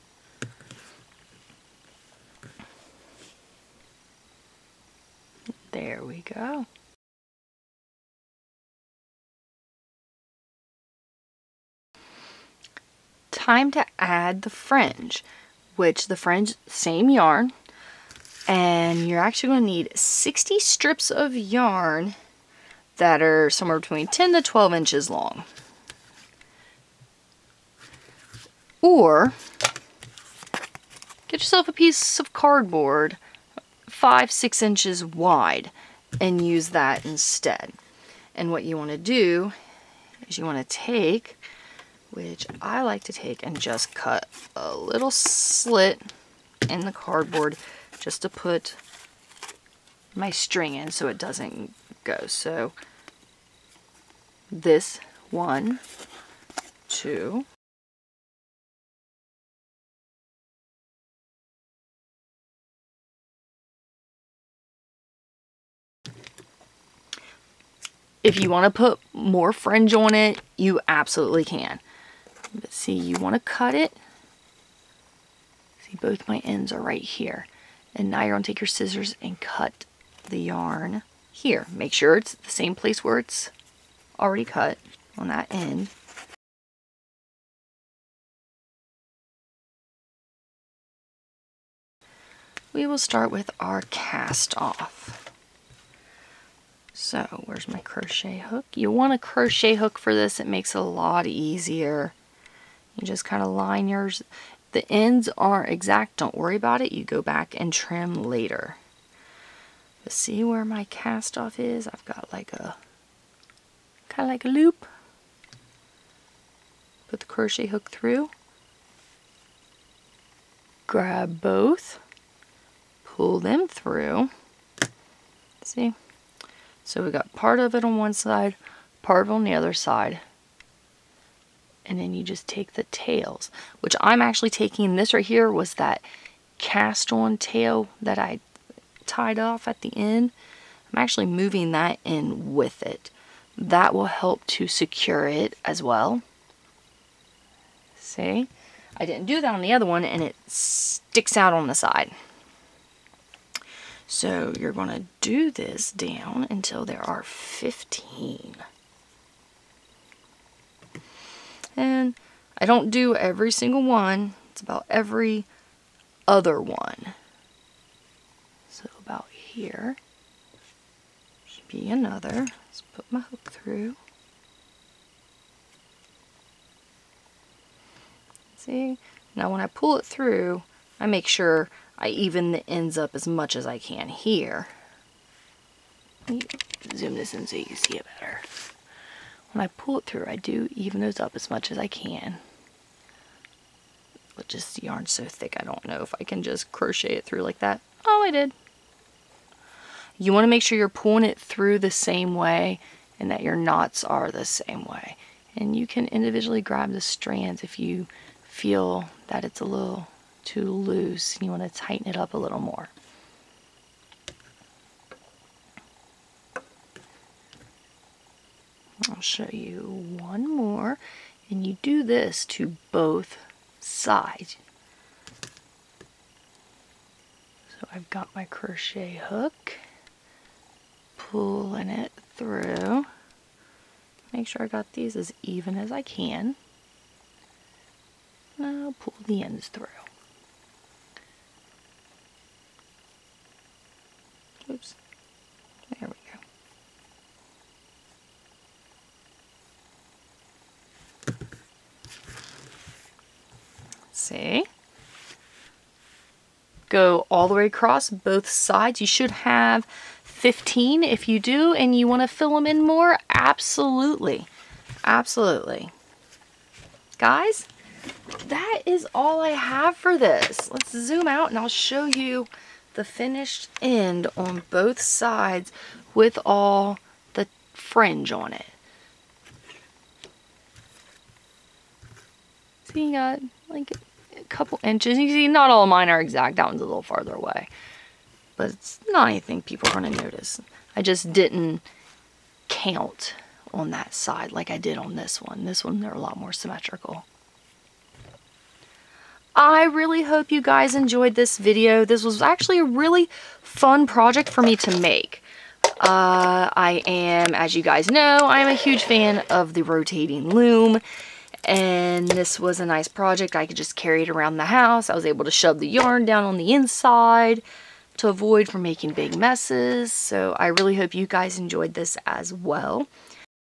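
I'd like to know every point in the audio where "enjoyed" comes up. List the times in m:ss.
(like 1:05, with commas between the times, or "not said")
5:00, 5:21.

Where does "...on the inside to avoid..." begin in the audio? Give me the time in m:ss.
5:16.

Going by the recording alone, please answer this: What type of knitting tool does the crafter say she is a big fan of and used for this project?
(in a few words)
Rotating loom.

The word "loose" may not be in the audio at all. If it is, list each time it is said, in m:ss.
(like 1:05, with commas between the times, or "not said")
3:30.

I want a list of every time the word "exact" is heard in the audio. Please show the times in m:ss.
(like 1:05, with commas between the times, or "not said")
1:45, 4:46.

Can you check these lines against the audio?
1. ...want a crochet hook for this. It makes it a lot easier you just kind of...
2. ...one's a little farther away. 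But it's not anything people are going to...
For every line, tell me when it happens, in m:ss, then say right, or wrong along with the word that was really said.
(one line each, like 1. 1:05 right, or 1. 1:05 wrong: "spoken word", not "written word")
1. 1:38 right
2. 4:46 right.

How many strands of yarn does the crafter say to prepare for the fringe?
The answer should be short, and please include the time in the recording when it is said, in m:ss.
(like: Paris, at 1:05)
60, at 0:19.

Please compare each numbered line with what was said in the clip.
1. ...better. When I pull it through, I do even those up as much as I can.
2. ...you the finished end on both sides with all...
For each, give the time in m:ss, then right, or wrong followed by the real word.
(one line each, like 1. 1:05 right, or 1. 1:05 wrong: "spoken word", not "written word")
1. 3:08 right
2. 4:32 right.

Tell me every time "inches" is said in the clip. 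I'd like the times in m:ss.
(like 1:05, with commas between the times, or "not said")
0:24, 0:34, 4:44.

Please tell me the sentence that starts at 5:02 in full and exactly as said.
This was actually a really fun project for me to make.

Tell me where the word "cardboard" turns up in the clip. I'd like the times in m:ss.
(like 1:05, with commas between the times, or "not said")
0:32, 0:46.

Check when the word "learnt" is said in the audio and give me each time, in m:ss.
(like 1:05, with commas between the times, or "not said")
not said.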